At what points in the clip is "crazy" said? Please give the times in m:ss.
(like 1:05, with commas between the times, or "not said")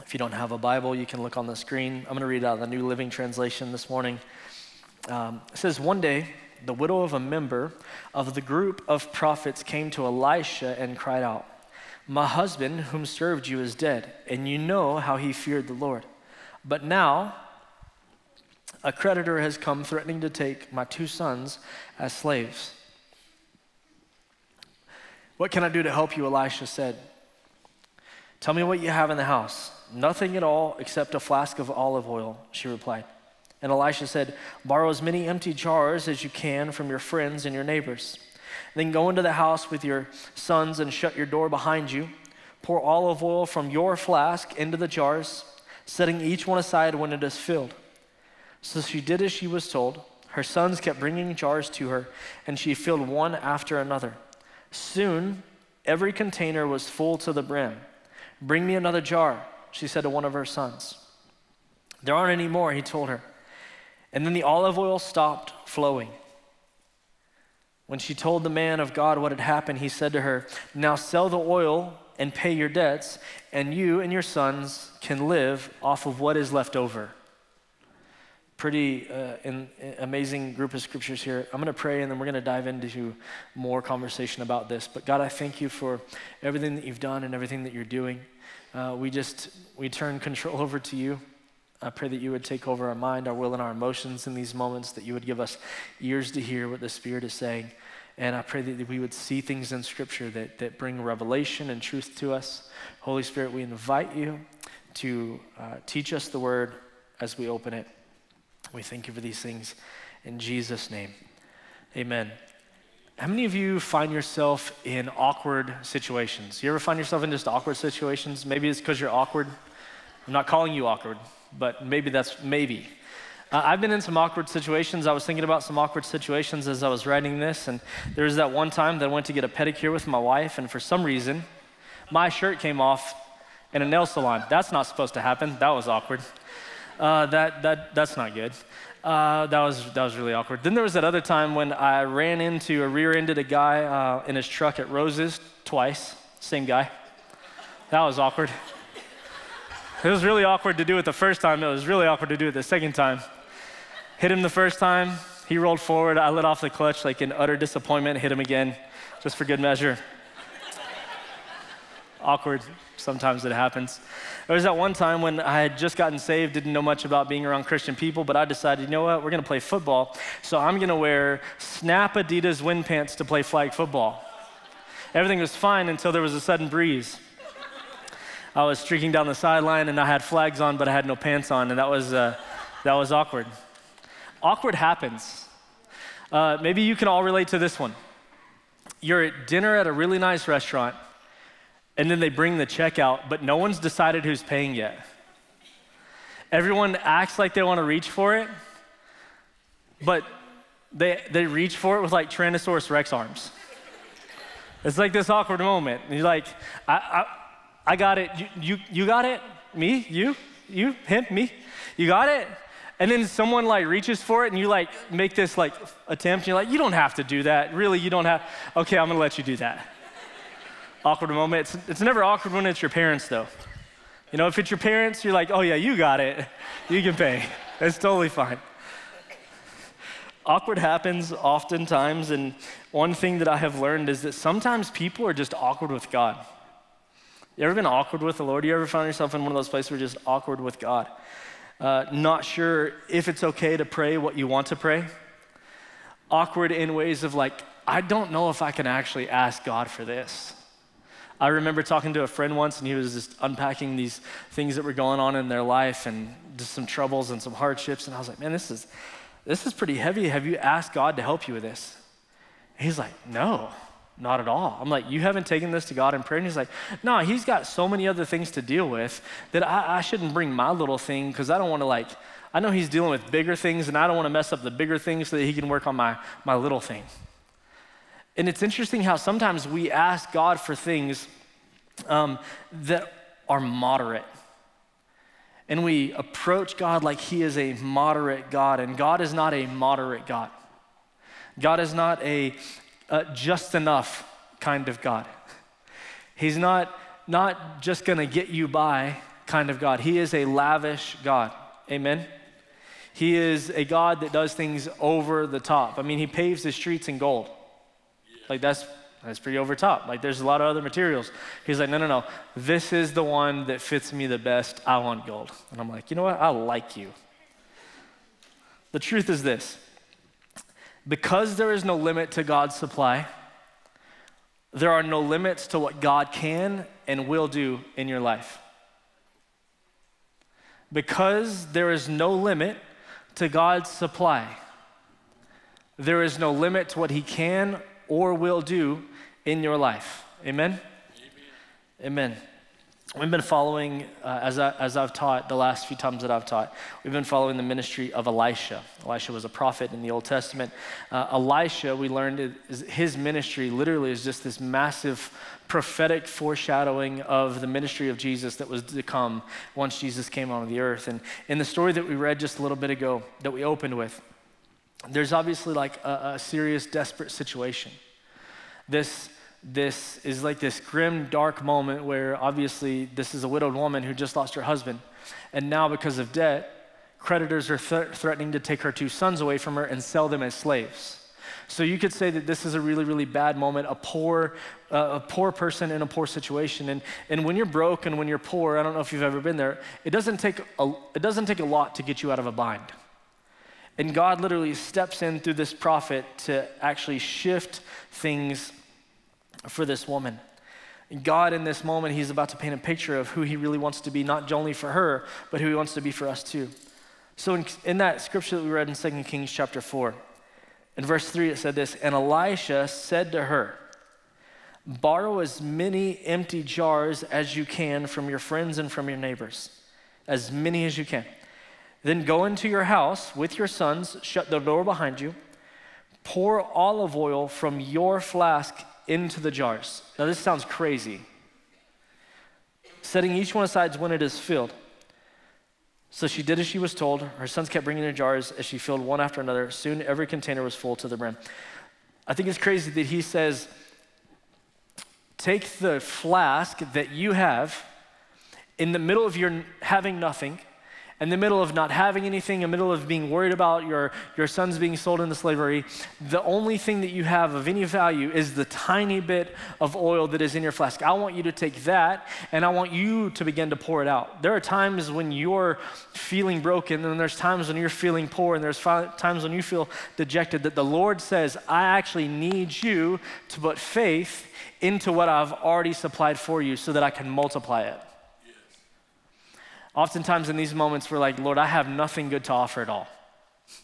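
7:10, 7:22.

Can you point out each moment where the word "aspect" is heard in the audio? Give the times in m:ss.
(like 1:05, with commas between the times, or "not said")
not said.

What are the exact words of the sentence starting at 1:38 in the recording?
And I pray that we would see things in Scripture that, that bring revelation and truth to us.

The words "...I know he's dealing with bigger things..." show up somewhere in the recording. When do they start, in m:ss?
4:32.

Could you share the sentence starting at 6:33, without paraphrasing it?
And God literally steps in through this prophet to actually shift things for this woman.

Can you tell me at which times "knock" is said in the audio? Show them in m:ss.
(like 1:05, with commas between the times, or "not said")
not said.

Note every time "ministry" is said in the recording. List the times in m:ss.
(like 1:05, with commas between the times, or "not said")
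5:47, 5:53, 5:57.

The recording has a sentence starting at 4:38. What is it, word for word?
And it's interesting how sometimes we ask God for things um, that are moderate.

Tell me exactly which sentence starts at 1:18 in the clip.
Pretty uh, in, in, uh, amazing group of scriptures here.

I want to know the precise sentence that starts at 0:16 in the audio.
But now, a creditor has come threatening to take my two sons as slaves.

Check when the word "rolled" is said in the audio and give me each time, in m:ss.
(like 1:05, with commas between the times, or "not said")
2:35.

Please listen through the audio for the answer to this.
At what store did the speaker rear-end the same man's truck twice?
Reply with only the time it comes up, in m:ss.
2:24.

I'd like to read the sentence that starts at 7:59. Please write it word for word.
Oftentimes in these moments, we're like, Lord, I have nothing good to offer at all.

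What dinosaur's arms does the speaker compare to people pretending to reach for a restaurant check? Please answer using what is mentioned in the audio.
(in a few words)
Tyrannosaurus Rex.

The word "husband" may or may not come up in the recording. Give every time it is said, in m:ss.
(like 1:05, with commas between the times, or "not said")
0:12, 6:14.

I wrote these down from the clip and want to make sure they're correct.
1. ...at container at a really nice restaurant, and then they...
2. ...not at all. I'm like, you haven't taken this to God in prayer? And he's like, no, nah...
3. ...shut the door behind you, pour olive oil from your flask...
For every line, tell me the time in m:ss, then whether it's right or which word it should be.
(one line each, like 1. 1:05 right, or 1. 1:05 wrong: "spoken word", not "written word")
1. 3:09 wrong: "dinner", not "container"
2. 4:24 right
3. 7:04 right.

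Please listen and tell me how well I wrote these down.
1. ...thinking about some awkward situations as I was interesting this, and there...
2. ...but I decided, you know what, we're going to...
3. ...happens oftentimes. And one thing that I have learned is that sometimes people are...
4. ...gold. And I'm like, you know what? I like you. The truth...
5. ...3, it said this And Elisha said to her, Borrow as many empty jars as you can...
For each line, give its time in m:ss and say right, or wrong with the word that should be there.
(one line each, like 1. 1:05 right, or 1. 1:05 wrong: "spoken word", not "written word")
1. 2:05 wrong: "writing", not "interesting"
2. 2:48 right
3. 3:50 right
4. 5:15 right
5. 6:51 right.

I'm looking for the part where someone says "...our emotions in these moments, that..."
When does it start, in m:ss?
1:33.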